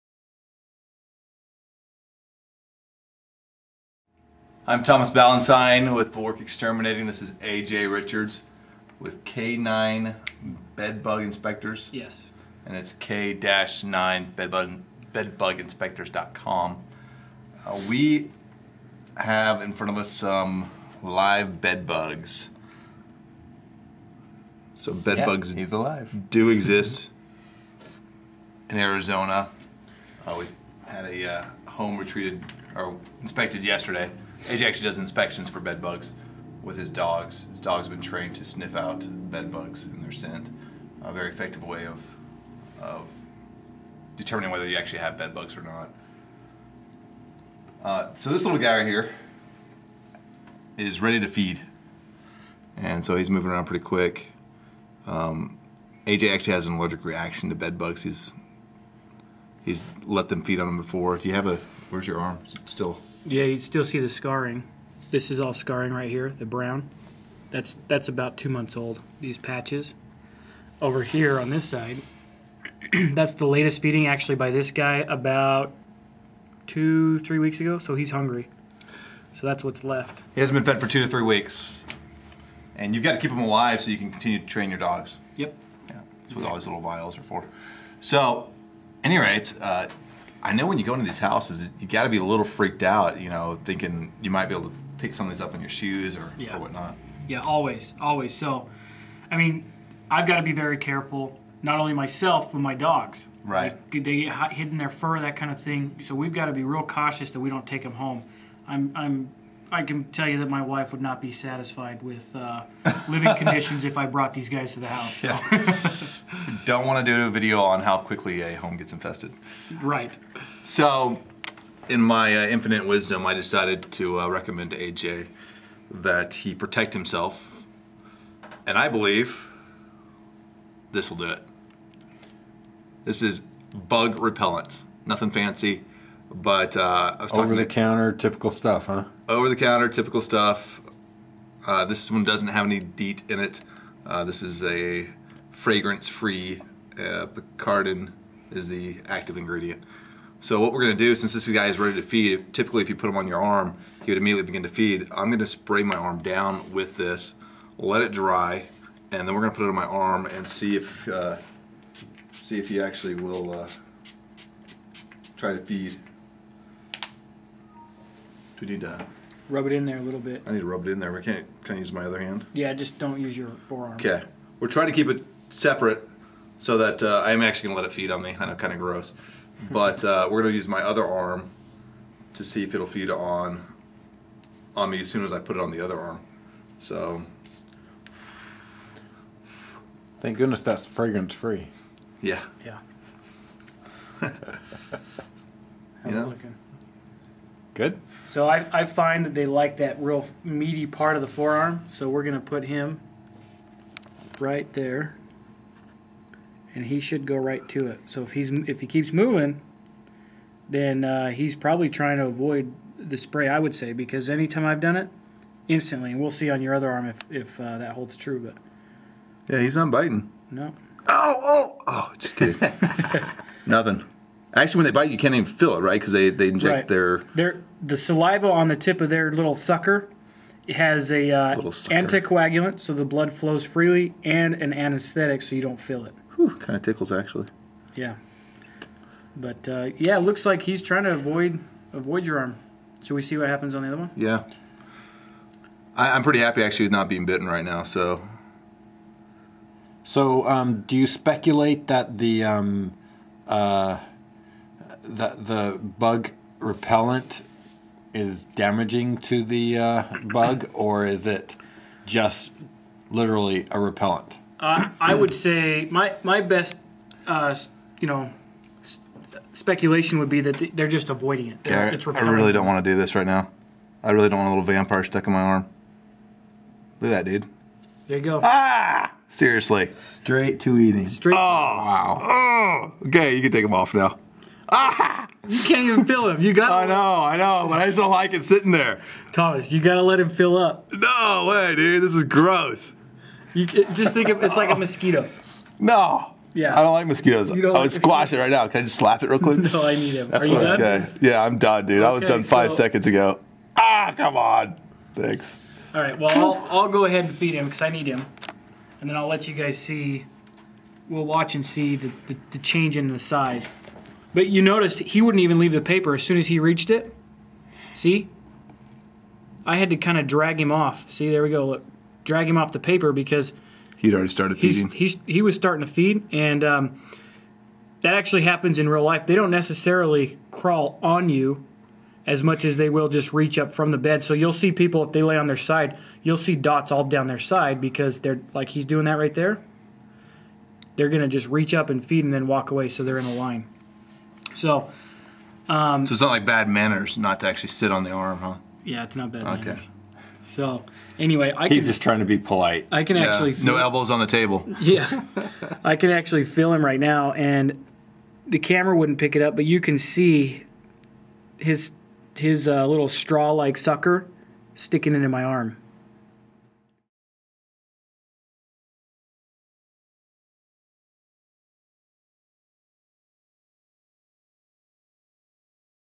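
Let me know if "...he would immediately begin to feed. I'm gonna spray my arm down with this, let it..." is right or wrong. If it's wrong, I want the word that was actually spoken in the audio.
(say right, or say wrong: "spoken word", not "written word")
right.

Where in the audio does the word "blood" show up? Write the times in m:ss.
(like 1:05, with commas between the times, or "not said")
3:53.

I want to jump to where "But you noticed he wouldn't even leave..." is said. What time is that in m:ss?
5:14.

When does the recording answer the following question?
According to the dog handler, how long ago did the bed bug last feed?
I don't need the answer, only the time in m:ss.
1:20.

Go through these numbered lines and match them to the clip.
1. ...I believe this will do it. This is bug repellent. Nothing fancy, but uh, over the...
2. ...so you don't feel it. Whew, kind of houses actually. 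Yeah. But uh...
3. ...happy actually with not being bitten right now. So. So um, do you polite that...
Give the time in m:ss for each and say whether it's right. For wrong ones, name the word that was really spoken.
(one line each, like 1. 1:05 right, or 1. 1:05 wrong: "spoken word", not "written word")
1. 2:08 right
2. 3:55 wrong: "tickles", not "houses"
3. 4:06 wrong: "speculate", not "polite".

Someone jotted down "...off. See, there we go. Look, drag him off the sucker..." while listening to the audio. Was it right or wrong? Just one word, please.
wrong.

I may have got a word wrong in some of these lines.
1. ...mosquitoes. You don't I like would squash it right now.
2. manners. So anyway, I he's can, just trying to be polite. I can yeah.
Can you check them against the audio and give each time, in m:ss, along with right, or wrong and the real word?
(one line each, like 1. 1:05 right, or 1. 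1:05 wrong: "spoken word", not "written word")
1. 4:57 right
2. 5:49 right.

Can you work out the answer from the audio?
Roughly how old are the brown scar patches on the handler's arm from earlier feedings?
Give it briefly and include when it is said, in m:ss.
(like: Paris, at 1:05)
2 months, at 1:08.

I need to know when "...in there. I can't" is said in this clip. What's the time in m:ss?
2:50.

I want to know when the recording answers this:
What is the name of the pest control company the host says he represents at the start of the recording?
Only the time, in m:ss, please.
0:06.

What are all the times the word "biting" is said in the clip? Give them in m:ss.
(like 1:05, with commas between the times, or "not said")
3:39.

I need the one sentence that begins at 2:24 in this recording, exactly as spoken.
Uh, this is a fragrance-free uh, Picardin is the active ingredient.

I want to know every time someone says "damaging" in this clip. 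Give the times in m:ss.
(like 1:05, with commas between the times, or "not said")
4:18.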